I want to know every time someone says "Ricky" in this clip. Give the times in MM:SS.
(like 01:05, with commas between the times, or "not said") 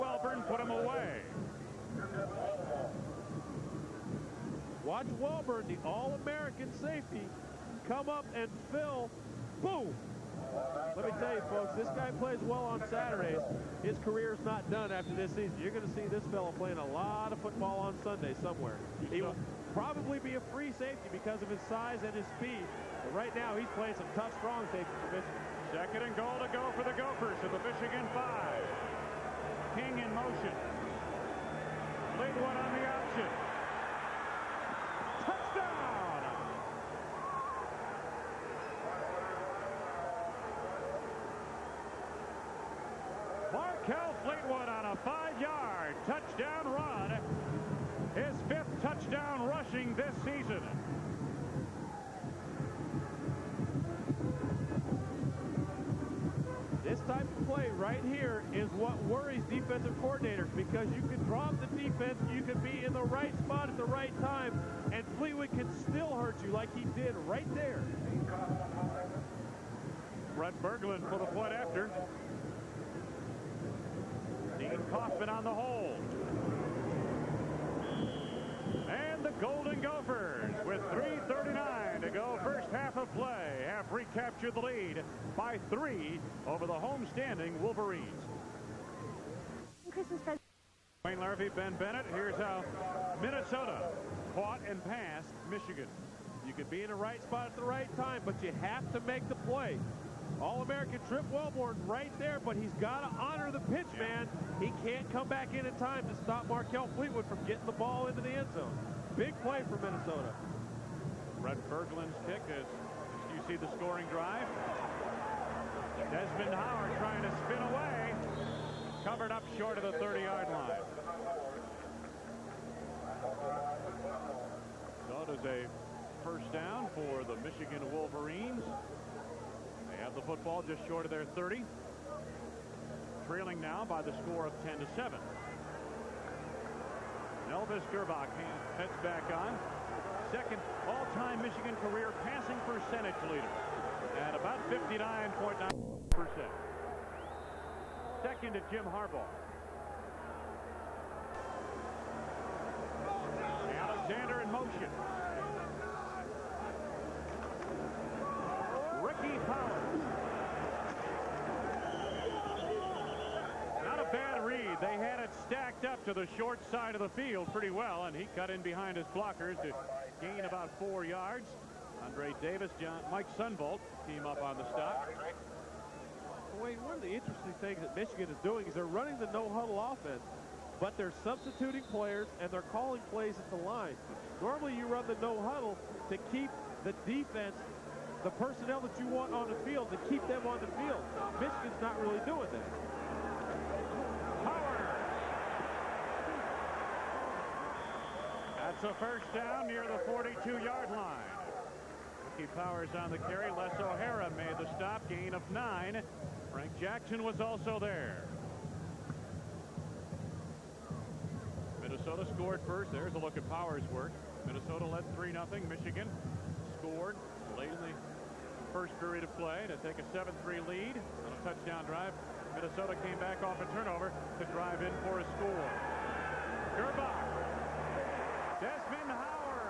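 02:39, 03:22.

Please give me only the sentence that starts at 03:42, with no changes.
Minnesota came back off a turnover to drive in for a score.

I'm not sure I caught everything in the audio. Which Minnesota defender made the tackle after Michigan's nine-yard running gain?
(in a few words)
Les O'Hara.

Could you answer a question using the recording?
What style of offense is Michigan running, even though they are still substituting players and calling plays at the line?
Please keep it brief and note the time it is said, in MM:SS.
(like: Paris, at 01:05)
no-huddle offense, at 02:59.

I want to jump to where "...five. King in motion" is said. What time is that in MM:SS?
00:28.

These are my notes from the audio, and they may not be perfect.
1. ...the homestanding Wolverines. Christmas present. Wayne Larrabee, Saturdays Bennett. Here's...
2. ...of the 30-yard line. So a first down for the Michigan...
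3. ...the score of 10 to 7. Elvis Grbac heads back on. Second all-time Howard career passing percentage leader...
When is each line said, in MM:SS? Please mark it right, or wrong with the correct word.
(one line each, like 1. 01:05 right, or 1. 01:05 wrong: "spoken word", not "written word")
1. 01:26 wrong: "Ben", not "Saturdays"
2. 01:59 right
3. 02:14 wrong: "Michigan", not "Howard".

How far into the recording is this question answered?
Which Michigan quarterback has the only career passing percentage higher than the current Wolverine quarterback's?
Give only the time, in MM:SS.
02:28.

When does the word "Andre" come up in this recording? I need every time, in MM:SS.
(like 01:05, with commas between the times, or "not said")
02:52.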